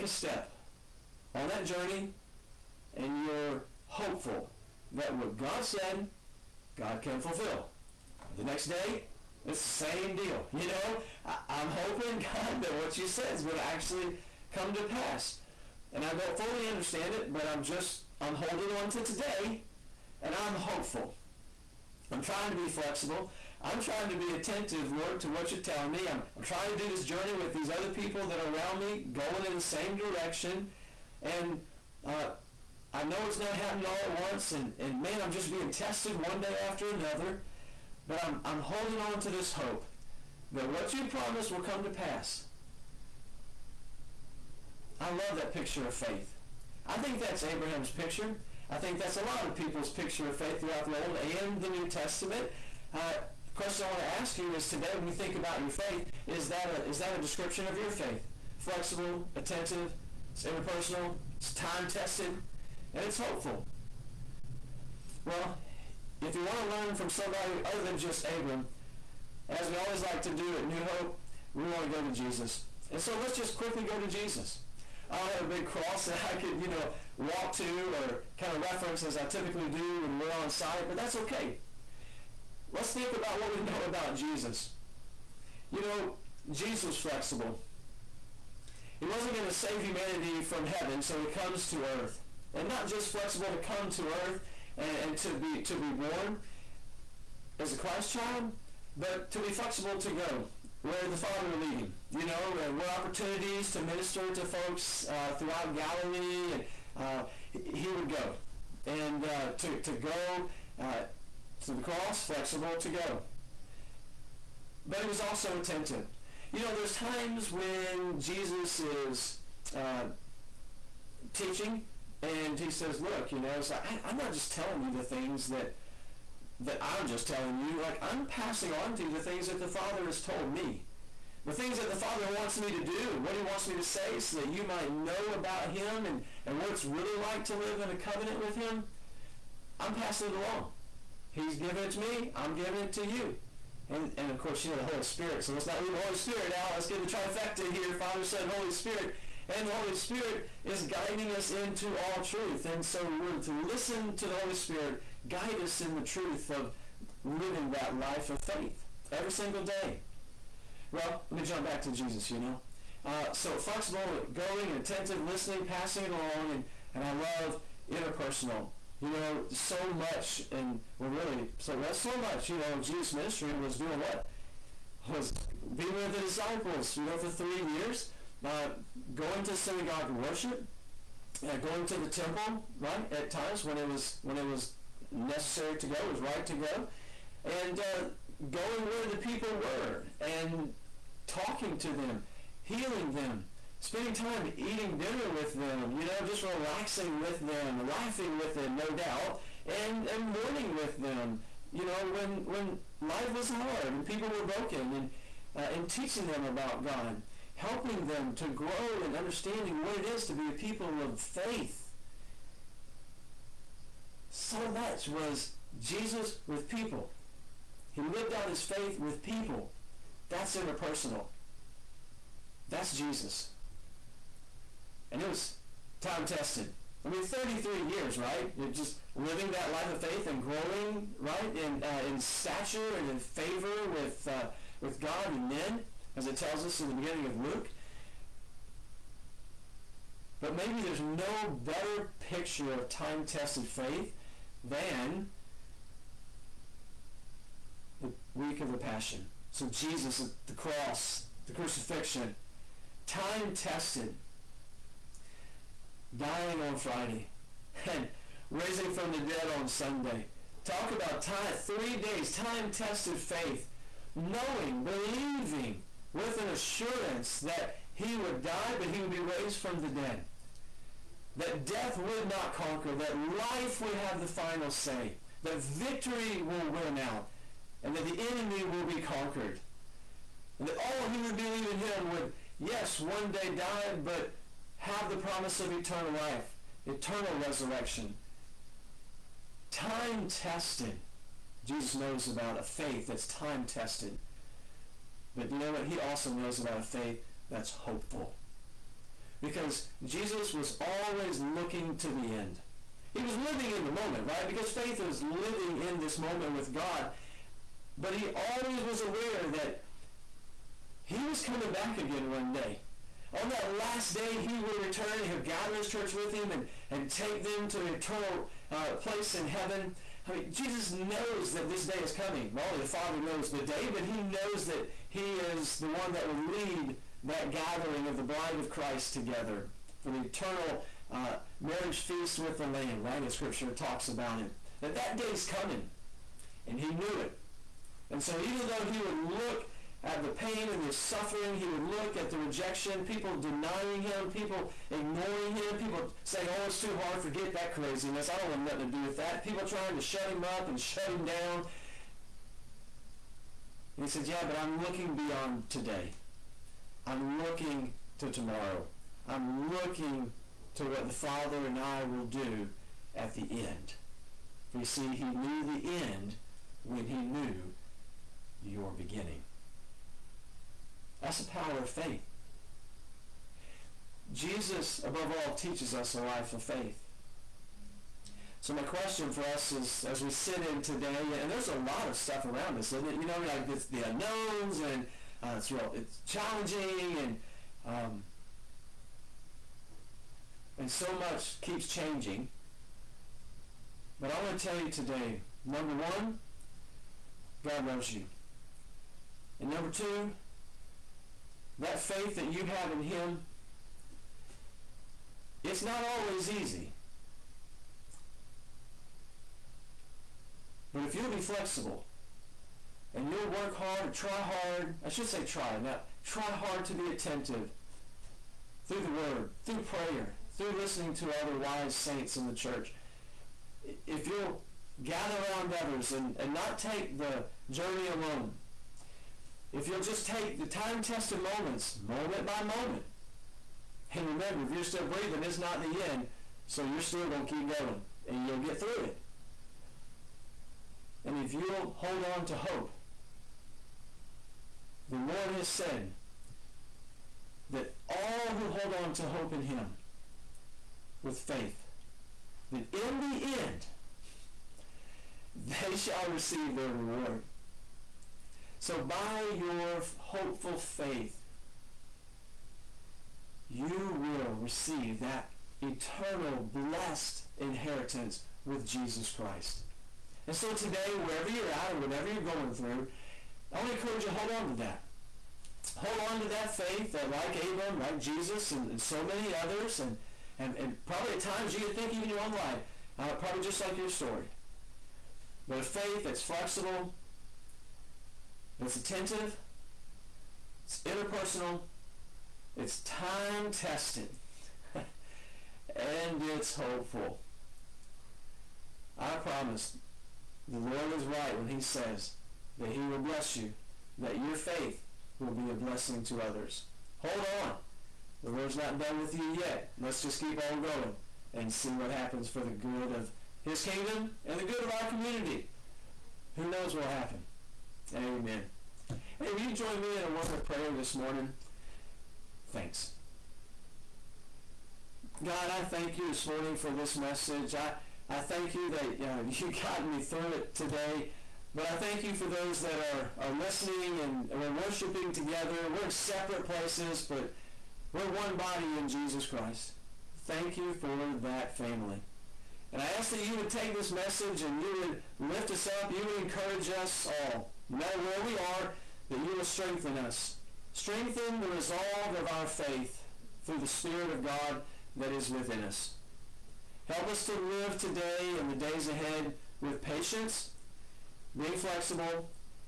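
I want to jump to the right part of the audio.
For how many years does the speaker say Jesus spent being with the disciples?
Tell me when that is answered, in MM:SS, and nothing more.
02:57.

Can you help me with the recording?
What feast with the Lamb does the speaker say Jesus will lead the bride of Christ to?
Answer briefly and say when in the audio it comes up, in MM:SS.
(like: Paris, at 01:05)
marriage feast, at 05:31.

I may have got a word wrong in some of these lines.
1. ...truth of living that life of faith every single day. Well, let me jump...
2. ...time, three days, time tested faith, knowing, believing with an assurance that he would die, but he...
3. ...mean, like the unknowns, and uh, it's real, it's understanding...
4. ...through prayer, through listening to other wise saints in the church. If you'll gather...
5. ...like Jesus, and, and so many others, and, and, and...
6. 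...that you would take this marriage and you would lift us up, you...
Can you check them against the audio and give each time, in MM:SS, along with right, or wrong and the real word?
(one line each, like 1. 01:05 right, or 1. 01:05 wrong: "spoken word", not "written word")
1. 02:35 right
2. 04:21 right
3. 06:23 wrong: "challenging", not "understanding"
4. 06:59 right
5. 07:57 right
6. 09:03 wrong: "message", not "marriage".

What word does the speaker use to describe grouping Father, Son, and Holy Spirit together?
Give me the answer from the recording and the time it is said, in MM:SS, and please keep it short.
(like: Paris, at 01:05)
trifecta, at 02:27.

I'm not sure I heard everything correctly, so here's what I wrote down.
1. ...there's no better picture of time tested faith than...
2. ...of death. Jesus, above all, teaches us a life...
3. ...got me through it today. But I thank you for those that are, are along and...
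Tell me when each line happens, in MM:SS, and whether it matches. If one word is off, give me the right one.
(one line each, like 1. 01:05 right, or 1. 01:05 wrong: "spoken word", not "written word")
1. 04:00 right
2. 06:11 wrong: "faith", not "death"
3. 08:49 wrong: "listening", not "along".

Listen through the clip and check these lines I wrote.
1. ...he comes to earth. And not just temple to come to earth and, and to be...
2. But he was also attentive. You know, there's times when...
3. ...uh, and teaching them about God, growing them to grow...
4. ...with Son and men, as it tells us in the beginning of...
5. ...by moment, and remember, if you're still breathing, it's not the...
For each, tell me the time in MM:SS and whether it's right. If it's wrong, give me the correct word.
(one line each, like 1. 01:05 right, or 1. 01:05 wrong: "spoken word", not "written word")
1. 01:31 wrong: "flexible", not "temple"
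2. 01:54 right
3. 03:25 wrong: "helping", not "growing"
4. 03:54 wrong: "God", not "Son"
5. 07:12 right.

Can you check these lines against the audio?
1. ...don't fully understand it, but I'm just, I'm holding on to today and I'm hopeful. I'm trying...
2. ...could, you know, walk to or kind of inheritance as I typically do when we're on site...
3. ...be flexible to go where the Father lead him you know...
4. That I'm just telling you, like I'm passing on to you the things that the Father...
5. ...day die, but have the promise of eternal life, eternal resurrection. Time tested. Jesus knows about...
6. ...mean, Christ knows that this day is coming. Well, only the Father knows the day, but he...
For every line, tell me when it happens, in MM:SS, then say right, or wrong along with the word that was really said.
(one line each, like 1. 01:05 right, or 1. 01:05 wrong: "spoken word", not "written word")
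1. 00:16 right
2. 01:16 wrong: "reference", not "inheritance"
3. 01:39 right
4. 02:06 right
5. 04:43 right
6. 05:20 wrong: "Jesus", not "Christ".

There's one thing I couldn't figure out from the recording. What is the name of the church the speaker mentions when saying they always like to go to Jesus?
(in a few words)
New Hope.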